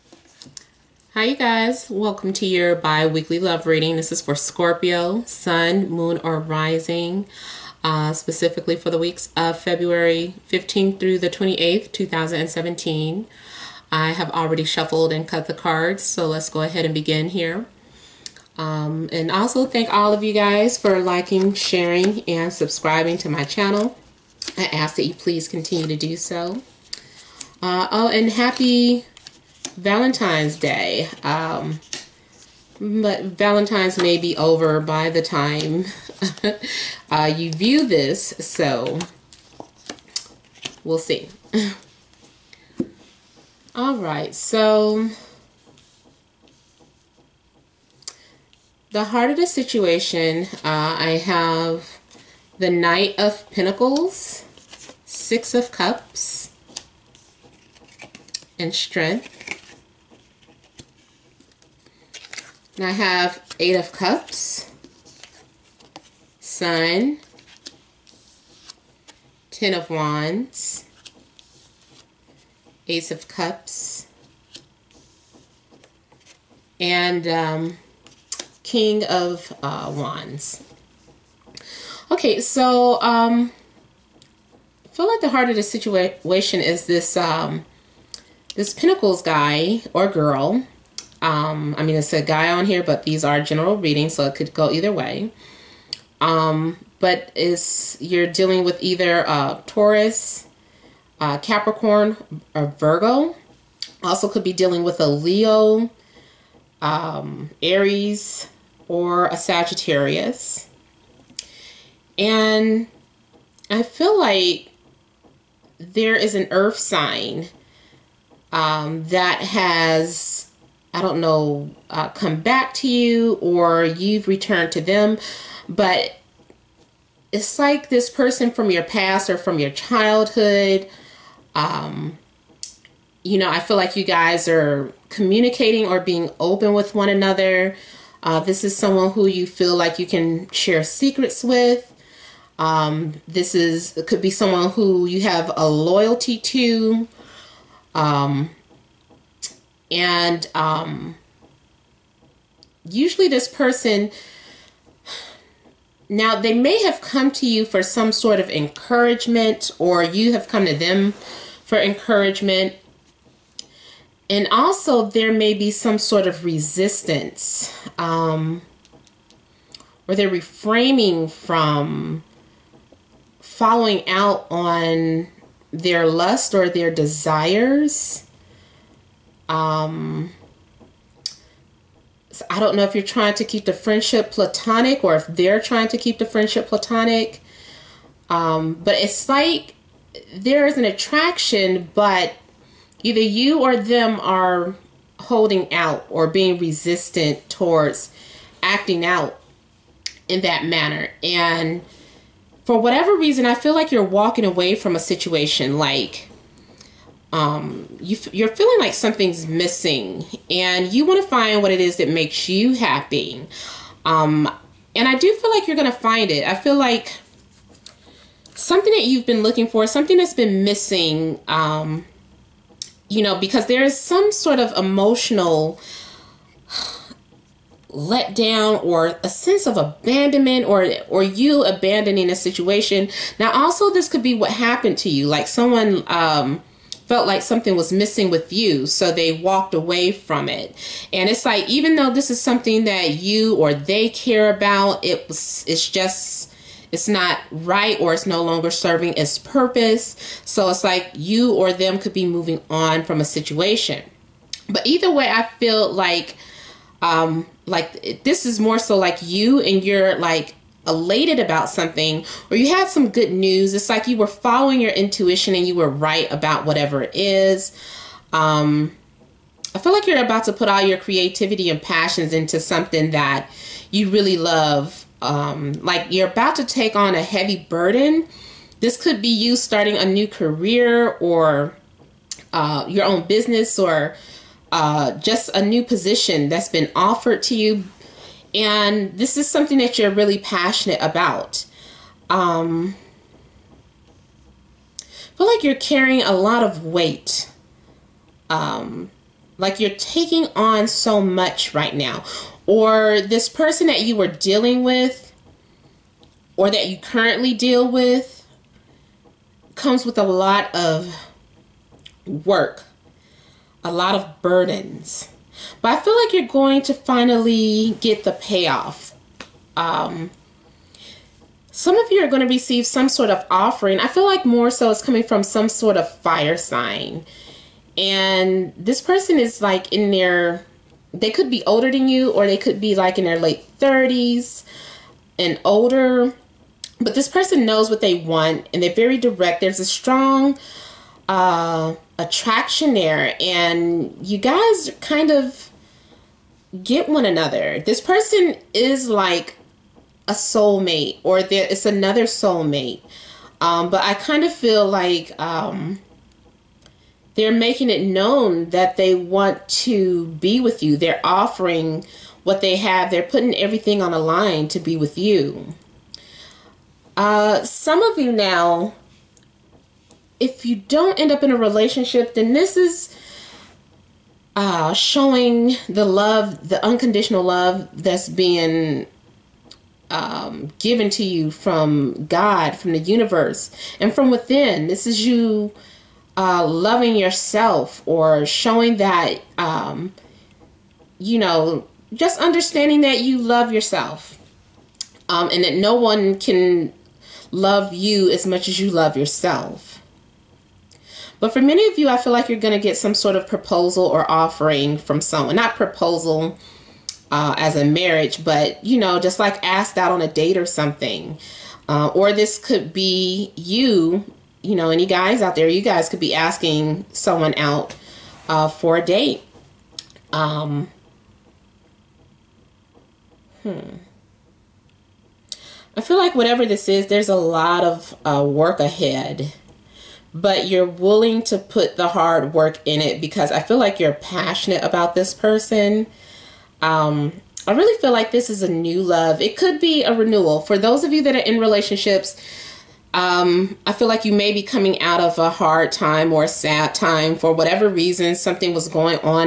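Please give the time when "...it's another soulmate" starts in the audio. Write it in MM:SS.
05:51.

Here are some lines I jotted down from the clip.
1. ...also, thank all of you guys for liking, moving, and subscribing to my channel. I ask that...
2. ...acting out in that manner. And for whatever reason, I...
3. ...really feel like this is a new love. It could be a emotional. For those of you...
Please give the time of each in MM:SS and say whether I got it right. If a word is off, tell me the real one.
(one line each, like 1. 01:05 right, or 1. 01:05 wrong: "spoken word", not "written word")
1. 00:19 wrong: "sharing", not "moving"
2. 03:18 right
3. 07:17 wrong: "renewal", not "emotional".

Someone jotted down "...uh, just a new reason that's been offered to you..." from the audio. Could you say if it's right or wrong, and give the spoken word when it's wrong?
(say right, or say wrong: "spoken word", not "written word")
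wrong: "position", not "reason".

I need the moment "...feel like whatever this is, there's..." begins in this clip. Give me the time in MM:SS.
07:06.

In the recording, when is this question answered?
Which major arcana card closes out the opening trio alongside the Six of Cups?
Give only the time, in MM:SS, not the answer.
00:58.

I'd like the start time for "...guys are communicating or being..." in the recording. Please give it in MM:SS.
02:14.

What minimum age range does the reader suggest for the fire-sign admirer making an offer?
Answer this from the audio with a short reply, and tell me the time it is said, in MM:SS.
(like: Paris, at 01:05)
late 30s, at 05:33.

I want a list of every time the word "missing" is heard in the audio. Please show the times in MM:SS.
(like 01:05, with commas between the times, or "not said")
03:29, 03:40, 03:57.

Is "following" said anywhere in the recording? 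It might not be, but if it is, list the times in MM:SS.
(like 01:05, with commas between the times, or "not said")
02:53, 04:24.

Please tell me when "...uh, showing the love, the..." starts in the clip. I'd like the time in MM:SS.
06:14.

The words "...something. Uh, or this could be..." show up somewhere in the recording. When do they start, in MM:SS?
06:50.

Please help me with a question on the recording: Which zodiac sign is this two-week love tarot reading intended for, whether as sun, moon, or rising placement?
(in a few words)
Scorpio.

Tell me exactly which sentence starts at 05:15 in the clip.
But I feel like you're going to finally get the payoff.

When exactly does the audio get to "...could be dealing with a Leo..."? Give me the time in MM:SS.
01:44.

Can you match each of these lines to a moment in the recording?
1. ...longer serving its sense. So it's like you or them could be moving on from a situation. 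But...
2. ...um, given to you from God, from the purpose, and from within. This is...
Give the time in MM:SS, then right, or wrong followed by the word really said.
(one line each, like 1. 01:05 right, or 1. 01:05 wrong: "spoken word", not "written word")
1. 04:08 wrong: "purpose", not "sense"
2. 06:20 wrong: "universe", not "purpose".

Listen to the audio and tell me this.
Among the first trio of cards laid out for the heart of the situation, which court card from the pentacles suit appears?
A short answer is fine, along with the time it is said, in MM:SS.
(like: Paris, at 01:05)
Knight of Pentacles, at 00:52.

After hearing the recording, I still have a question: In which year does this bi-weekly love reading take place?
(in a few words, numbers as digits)
2017.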